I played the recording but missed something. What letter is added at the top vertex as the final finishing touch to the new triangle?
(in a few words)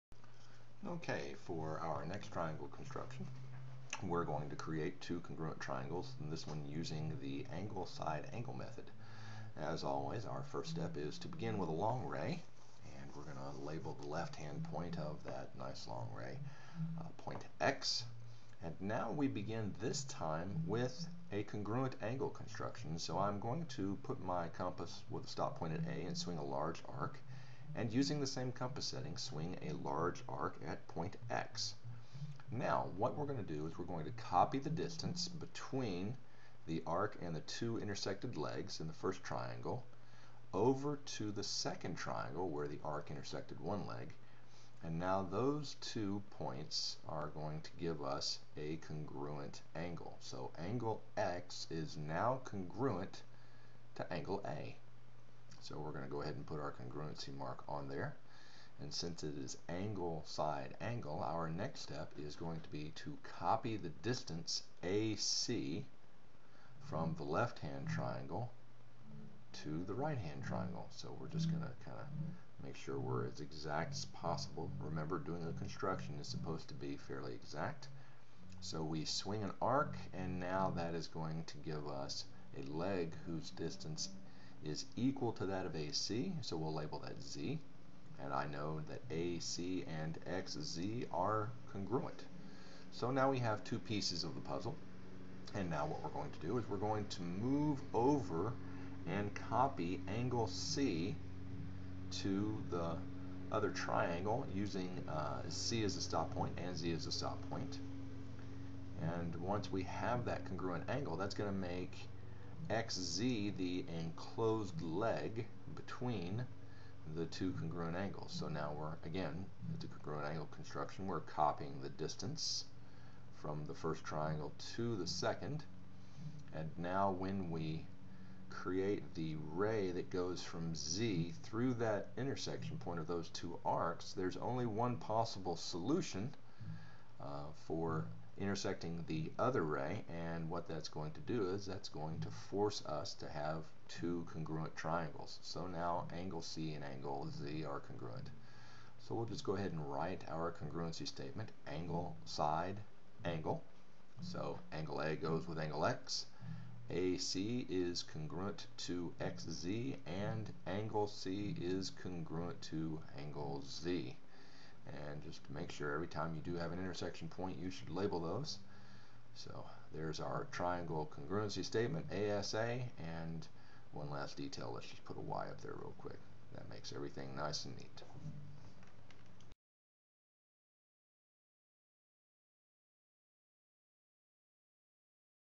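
Y.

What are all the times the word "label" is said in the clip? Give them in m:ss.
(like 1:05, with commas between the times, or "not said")
0:13, 1:26, 2:47.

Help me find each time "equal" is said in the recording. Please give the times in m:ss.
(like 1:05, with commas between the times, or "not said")
1:24.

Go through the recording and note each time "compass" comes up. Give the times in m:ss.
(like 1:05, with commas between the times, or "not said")
0:24, 0:28.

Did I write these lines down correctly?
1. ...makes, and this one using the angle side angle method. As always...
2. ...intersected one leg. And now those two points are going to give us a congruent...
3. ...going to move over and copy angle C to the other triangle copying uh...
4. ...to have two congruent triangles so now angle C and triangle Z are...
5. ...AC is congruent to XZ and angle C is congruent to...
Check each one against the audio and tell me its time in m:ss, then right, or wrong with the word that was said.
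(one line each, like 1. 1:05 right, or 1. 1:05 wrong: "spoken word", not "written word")
1. 0:05 wrong: "triangles", not "makes"
2. 0:43 right
3. 1:36 wrong: "using", not "copying"
4. 2:23 wrong: "angle", not "triangle"
5. 2:36 right.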